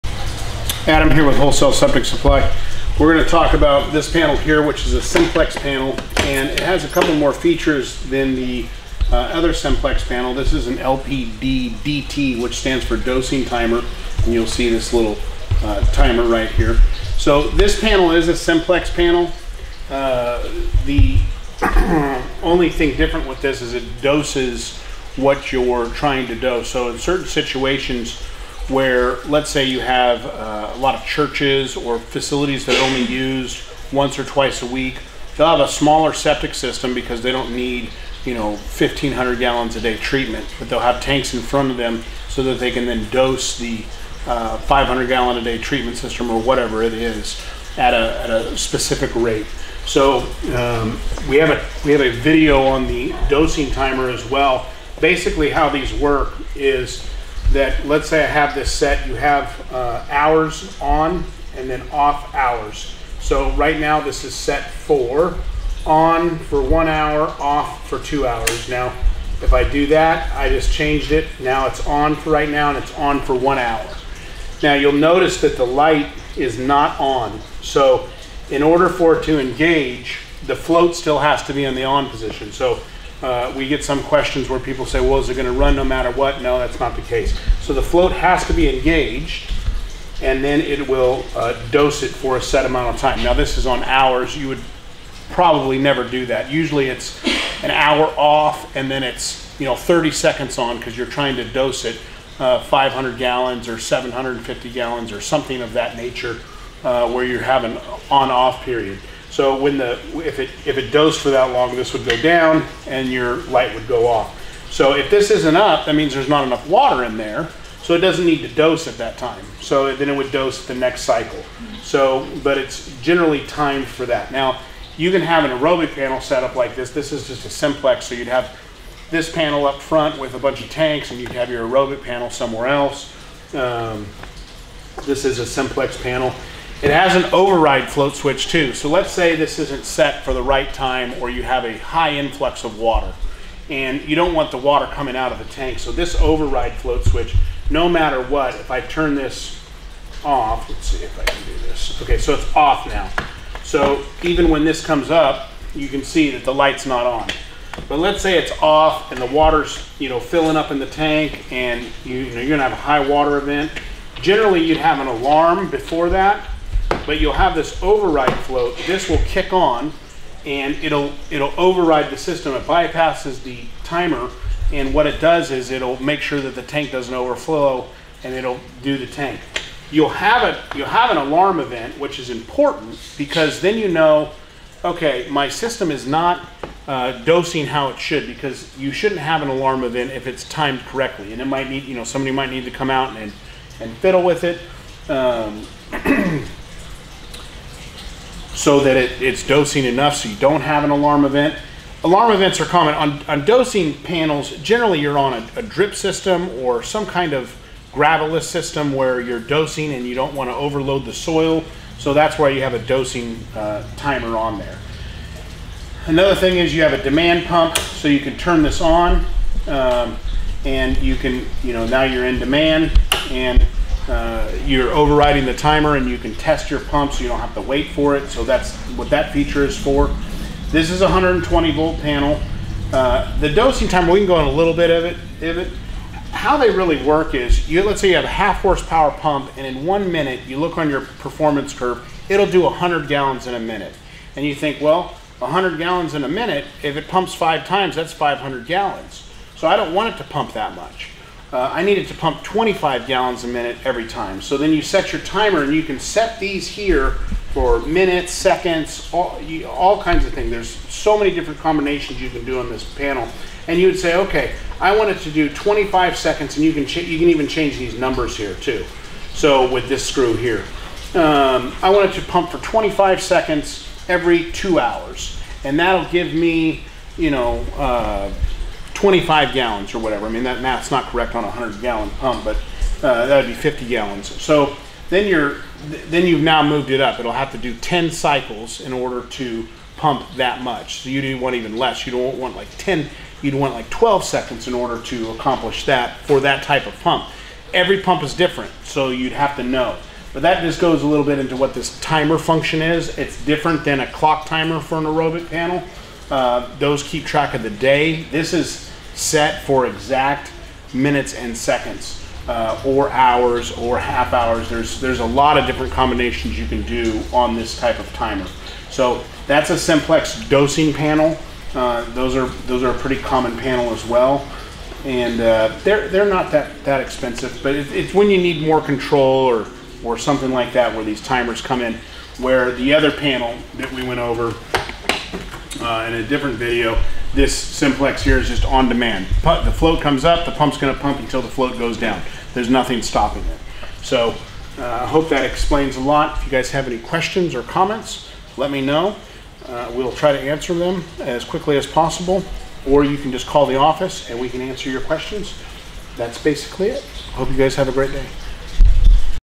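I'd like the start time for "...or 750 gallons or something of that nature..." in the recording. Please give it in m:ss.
1:43.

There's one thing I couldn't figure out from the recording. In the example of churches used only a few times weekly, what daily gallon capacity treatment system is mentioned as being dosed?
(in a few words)
500 gallon a day.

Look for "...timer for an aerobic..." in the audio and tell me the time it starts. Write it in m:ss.
5:04.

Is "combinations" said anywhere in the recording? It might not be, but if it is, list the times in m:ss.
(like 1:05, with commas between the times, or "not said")
4:21, 5:15.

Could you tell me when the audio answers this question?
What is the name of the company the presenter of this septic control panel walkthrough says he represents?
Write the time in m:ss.
0:01.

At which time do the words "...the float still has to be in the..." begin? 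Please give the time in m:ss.
1:20.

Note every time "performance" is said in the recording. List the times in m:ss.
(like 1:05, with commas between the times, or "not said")
4:01.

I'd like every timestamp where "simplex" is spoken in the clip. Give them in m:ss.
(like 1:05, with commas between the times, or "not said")
0:05, 0:09, 0:18, 2:07, 2:15, 5:19, 5:37.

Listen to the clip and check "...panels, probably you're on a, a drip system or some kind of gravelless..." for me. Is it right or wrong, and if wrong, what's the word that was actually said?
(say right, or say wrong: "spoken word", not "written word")
wrong: "generally", not "probably".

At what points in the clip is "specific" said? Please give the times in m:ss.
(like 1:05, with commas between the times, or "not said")
0:48.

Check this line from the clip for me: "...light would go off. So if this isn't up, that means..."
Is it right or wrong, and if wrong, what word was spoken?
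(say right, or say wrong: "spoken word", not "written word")
right.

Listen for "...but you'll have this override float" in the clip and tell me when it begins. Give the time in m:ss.
2:47.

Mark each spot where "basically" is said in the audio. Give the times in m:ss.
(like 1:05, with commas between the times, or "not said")
0:54, 5:56.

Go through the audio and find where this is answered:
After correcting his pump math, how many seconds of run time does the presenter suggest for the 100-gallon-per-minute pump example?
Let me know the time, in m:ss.
4:53.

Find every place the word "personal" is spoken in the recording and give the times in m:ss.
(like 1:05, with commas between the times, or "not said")
not said.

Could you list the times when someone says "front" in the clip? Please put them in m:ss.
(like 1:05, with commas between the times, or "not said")
0:41, 2:09.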